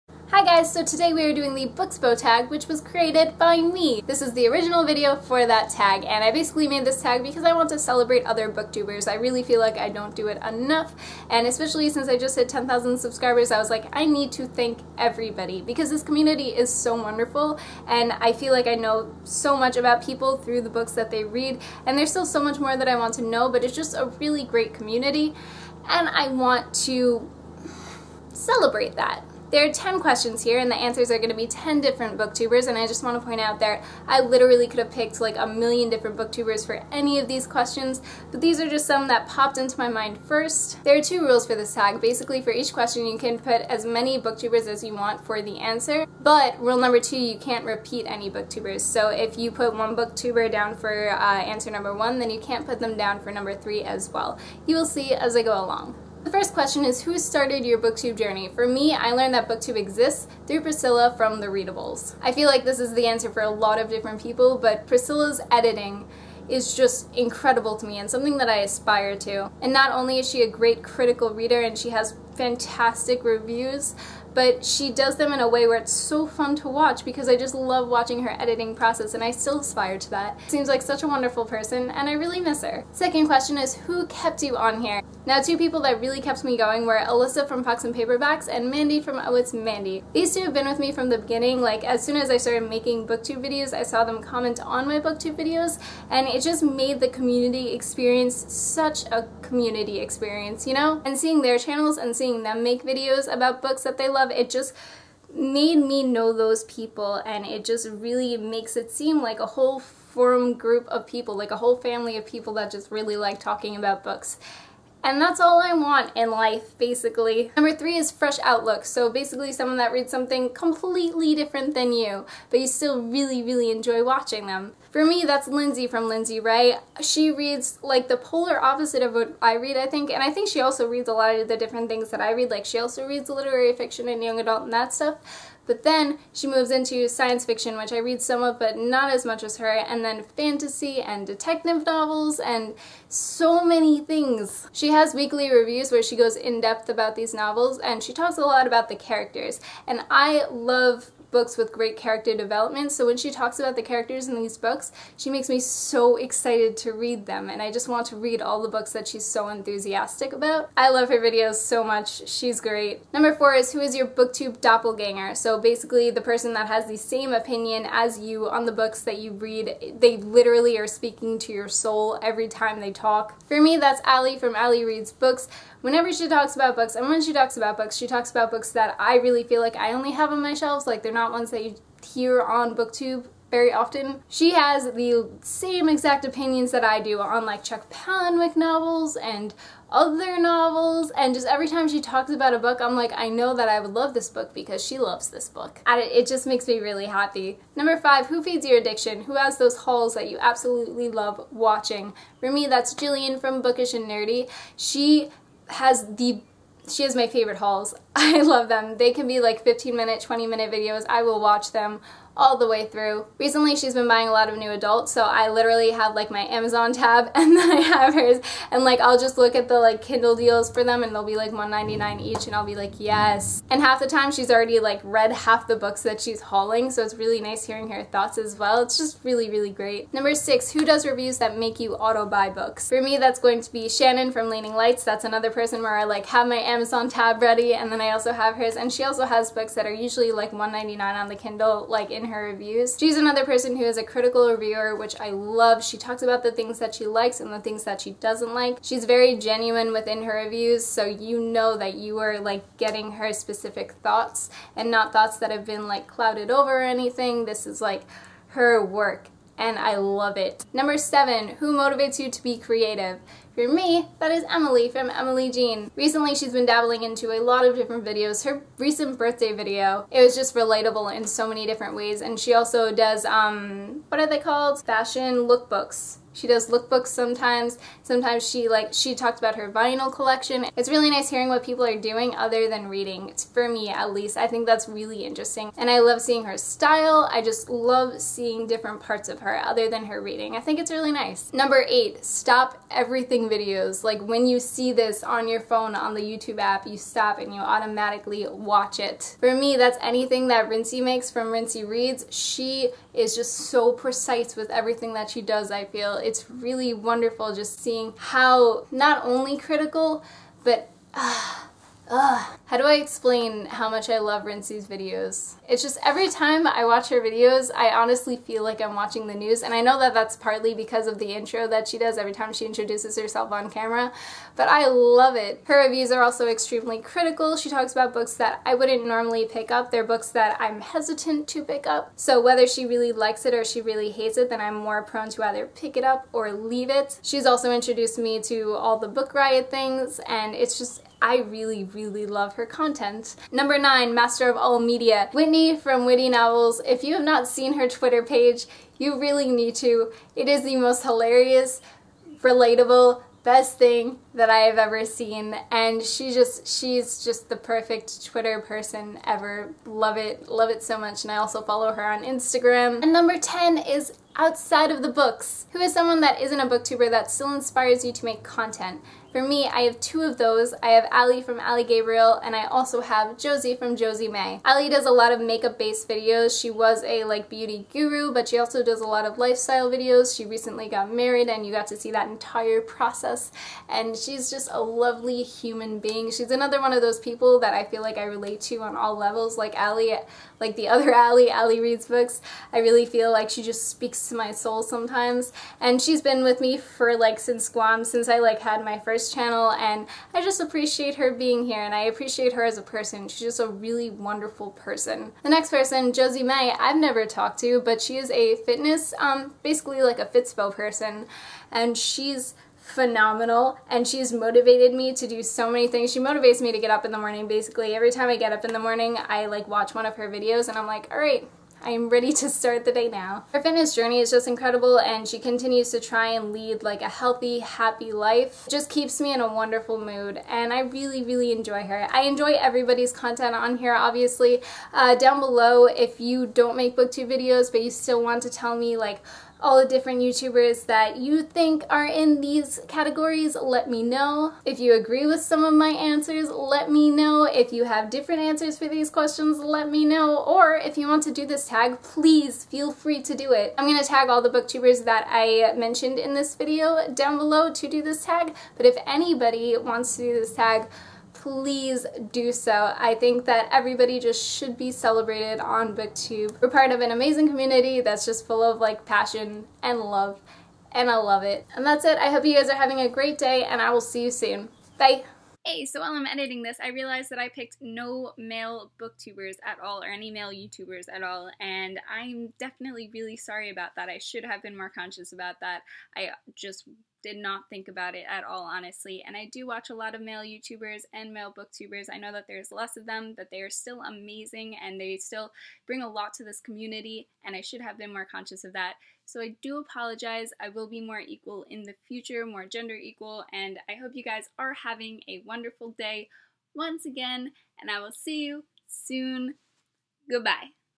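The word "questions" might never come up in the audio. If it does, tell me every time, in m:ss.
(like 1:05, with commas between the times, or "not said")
0:29, 0:37, 0:42, 0:56, 1:23, 7:29.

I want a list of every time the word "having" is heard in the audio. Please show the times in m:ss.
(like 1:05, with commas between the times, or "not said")
7:52, 8:24.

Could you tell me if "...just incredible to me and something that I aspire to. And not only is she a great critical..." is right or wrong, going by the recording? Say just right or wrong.
right.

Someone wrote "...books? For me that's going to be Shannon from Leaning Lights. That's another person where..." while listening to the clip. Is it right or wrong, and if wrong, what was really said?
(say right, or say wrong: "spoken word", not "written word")
right.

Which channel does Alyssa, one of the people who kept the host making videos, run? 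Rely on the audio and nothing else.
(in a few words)
Pucks and Paperbacks.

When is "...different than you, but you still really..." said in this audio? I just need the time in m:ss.
2:01.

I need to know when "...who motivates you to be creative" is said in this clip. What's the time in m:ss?
4:21.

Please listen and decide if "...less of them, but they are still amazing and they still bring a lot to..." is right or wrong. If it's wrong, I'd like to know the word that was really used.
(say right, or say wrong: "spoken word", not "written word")
right.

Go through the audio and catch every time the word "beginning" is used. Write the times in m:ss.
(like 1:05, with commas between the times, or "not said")
1:31.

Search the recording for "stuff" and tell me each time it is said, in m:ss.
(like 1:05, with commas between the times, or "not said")
2:14.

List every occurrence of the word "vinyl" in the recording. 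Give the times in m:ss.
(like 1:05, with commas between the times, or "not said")
4:39.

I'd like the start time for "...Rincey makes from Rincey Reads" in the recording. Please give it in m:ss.
5:00.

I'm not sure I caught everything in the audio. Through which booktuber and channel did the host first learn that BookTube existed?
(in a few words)
Priscilla from the readables.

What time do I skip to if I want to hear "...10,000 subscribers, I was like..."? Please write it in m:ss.
0:12.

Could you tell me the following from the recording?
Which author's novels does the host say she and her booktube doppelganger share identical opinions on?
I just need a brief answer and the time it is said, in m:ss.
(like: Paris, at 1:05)
Chuck Palahniuk, at 3:07.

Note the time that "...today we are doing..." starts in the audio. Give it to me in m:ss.
0:00.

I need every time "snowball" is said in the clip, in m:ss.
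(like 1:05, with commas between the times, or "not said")
not said.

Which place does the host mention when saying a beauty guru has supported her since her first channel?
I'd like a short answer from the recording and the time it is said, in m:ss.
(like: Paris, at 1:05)
Guam, at 6:37.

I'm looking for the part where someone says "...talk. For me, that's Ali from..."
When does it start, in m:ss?
2:52.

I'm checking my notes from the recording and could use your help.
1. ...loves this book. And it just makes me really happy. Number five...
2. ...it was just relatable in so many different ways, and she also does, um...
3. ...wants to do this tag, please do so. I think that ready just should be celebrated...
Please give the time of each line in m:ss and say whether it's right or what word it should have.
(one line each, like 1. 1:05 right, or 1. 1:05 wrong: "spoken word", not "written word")
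1. 3:14 right
2. 4:30 right
3. 7:39 wrong: "everybody", not "ready".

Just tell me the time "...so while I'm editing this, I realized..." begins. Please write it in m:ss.
7:55.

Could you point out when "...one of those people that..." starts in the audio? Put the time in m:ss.
6:26.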